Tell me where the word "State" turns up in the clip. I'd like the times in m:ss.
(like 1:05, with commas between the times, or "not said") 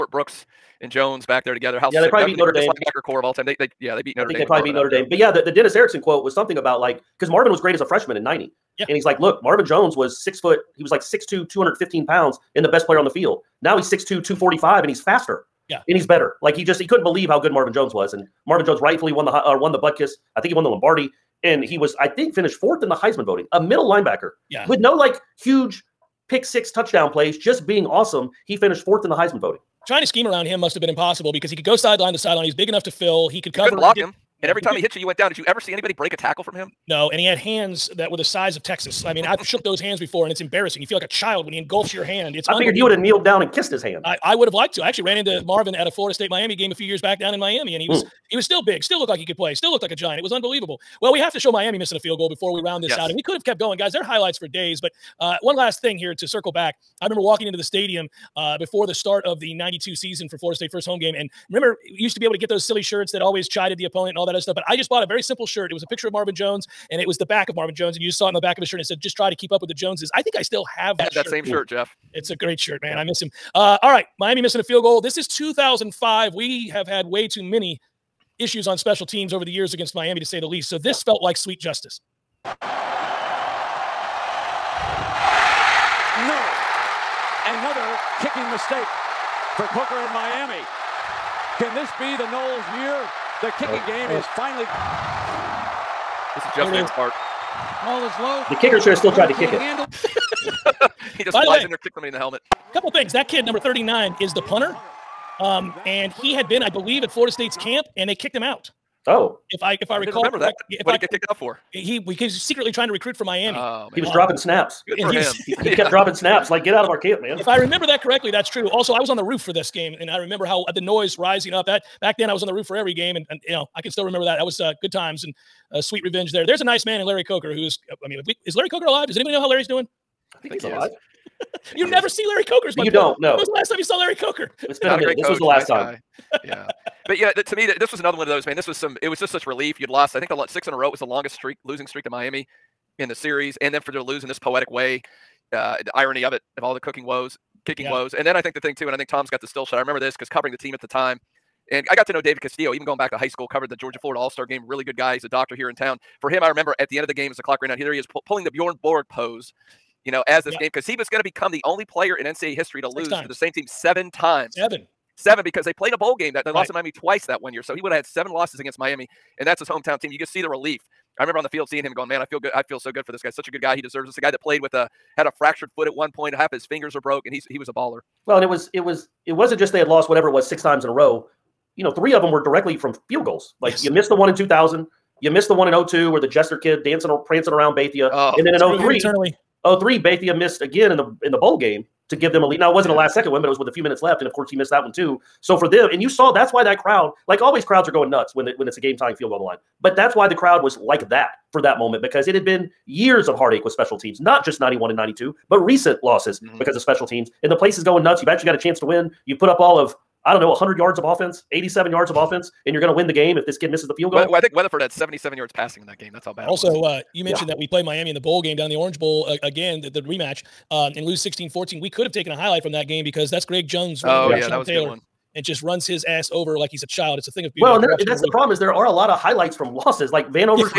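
0:46, 1:00, 1:47.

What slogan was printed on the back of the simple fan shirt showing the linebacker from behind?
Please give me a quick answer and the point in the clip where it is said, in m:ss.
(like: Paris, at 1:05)
just try to keep up with the Joneses, at 1:08.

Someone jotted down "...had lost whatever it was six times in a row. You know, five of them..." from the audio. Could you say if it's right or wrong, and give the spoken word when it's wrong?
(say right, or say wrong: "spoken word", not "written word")
wrong: "three", not "five".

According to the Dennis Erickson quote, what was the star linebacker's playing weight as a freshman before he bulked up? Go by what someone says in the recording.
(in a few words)
215 pounds.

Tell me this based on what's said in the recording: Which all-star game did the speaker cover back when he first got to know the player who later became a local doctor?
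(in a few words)
Georgia Florida All Star game.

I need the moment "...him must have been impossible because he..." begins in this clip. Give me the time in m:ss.
0:30.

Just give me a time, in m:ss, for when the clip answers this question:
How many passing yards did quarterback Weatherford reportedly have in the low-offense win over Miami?
3:34.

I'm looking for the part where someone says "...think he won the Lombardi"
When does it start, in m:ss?
0:20.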